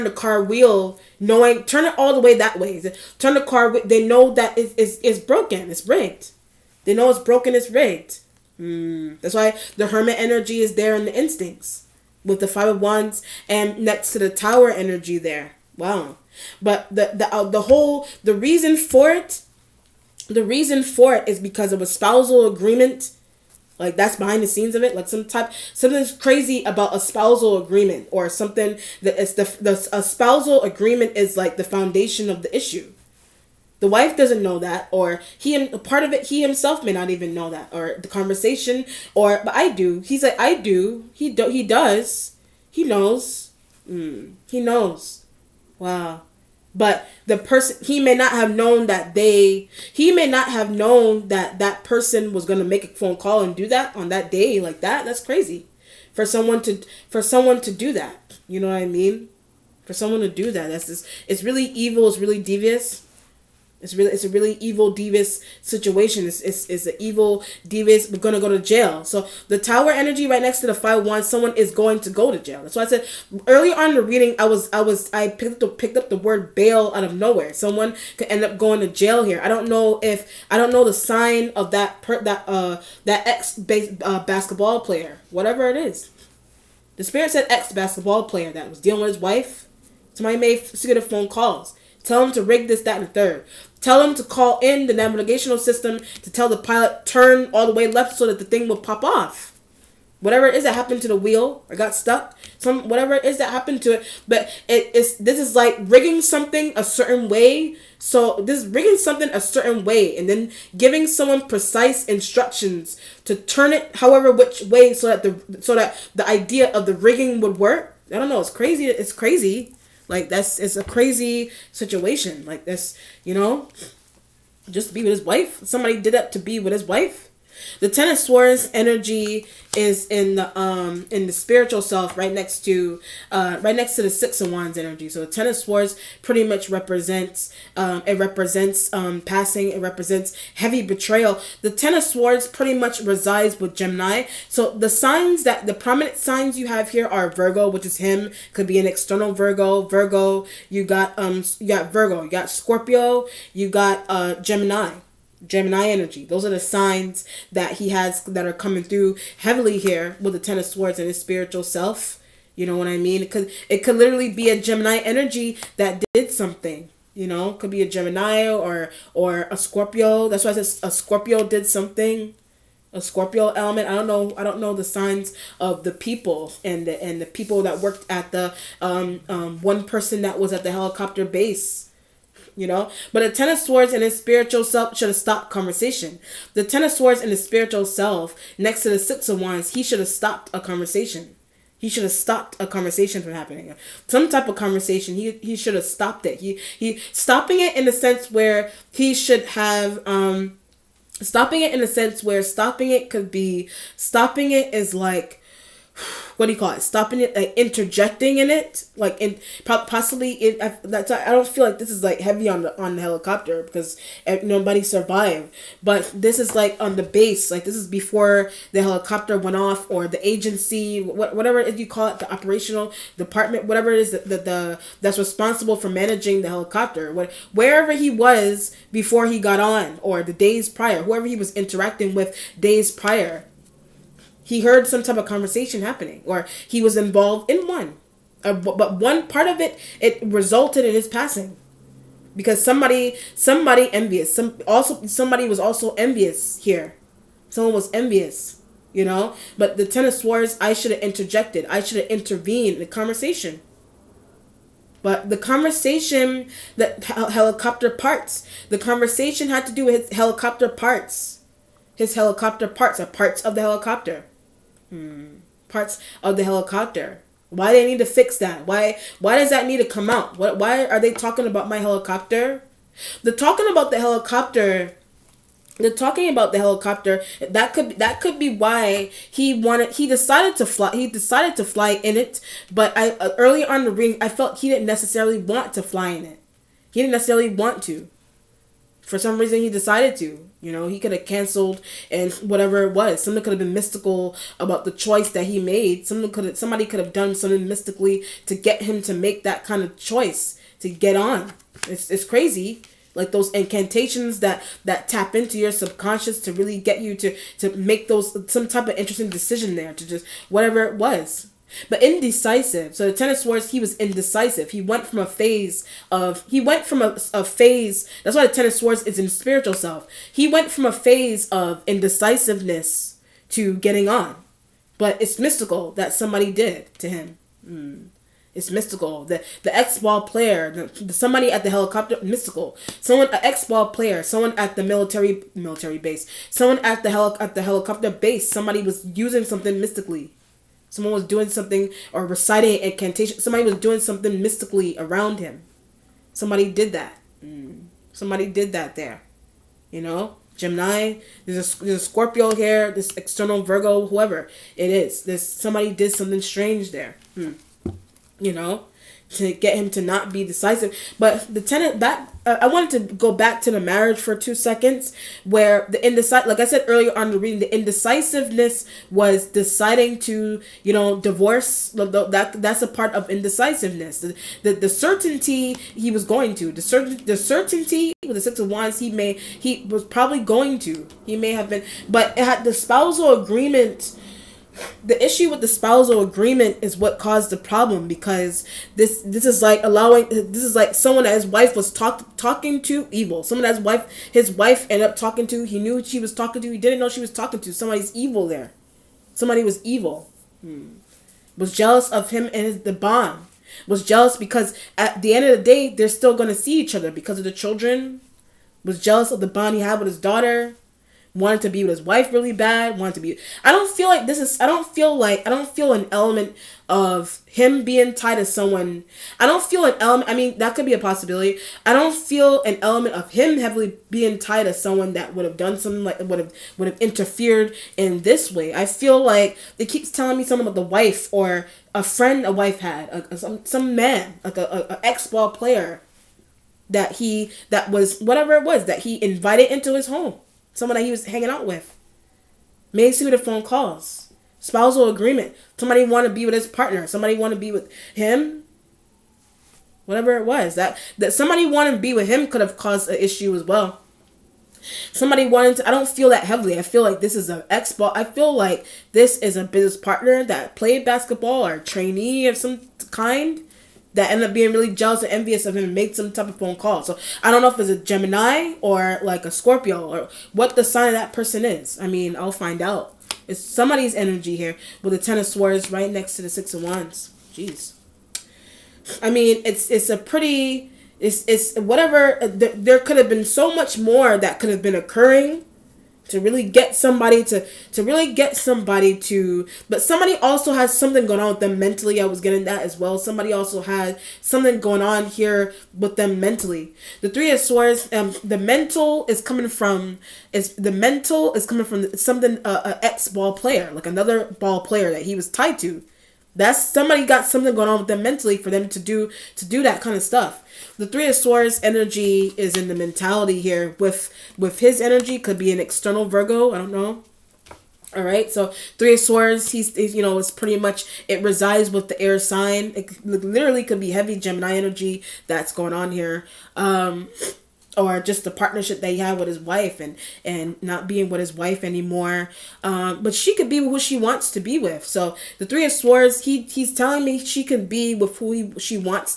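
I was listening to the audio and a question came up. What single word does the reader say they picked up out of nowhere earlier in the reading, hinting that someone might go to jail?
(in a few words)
bail.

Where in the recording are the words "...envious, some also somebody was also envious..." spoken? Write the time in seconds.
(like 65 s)
243 s.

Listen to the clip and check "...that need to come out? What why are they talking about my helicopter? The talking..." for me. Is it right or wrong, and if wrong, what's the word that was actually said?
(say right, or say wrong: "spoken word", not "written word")
right.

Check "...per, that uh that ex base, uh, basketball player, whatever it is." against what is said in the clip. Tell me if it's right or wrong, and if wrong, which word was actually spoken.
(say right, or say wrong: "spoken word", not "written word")
right.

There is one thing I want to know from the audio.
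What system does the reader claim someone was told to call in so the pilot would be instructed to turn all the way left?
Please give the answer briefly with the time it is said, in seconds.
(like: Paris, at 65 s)
navigational system, at 94 s.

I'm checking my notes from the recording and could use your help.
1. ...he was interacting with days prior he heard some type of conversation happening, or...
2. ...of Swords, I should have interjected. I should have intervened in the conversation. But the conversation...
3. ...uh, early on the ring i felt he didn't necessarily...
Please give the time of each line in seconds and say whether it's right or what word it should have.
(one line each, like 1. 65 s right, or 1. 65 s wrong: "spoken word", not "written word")
1. 231 s right
2. 250 s right
3. 283 s right.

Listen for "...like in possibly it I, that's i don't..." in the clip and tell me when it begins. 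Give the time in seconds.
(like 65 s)
208 s.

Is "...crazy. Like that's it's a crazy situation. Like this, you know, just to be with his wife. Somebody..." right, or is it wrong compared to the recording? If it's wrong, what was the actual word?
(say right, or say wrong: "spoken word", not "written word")
right.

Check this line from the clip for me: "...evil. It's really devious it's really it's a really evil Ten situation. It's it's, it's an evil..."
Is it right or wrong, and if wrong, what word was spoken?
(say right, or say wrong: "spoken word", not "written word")
wrong: "Divas", not "Ten".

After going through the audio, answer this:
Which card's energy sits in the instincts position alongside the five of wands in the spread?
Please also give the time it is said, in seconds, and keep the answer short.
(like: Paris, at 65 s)
The Hermit, at 9 s.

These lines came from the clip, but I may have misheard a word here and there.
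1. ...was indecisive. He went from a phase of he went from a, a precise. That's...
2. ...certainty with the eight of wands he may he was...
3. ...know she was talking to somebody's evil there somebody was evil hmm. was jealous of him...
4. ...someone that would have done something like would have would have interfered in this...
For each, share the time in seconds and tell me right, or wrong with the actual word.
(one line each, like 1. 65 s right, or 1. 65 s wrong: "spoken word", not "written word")
1. 313 s wrong: "phase", not "precise"
2. 377 s wrong: "six", not "eight"
3. 396 s right
4. 424 s right.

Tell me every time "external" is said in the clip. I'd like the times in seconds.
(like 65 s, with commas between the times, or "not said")
148 s, 353 s, 515 s.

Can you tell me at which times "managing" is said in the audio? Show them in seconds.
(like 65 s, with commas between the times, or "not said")
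225 s.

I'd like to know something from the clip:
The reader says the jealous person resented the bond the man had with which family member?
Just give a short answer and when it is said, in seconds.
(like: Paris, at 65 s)
his daughter, at 410 s.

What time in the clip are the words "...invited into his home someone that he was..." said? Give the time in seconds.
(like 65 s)
439 s.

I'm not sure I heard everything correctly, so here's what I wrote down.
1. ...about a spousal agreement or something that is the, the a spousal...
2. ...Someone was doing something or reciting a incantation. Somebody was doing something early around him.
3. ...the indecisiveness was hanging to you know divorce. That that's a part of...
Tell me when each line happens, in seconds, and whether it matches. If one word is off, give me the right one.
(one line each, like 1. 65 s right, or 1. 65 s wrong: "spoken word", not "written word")
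1. 26 s right
2. 340 s wrong: "mystically", not "early"
3. 367 s wrong: "deciding", not "hanging".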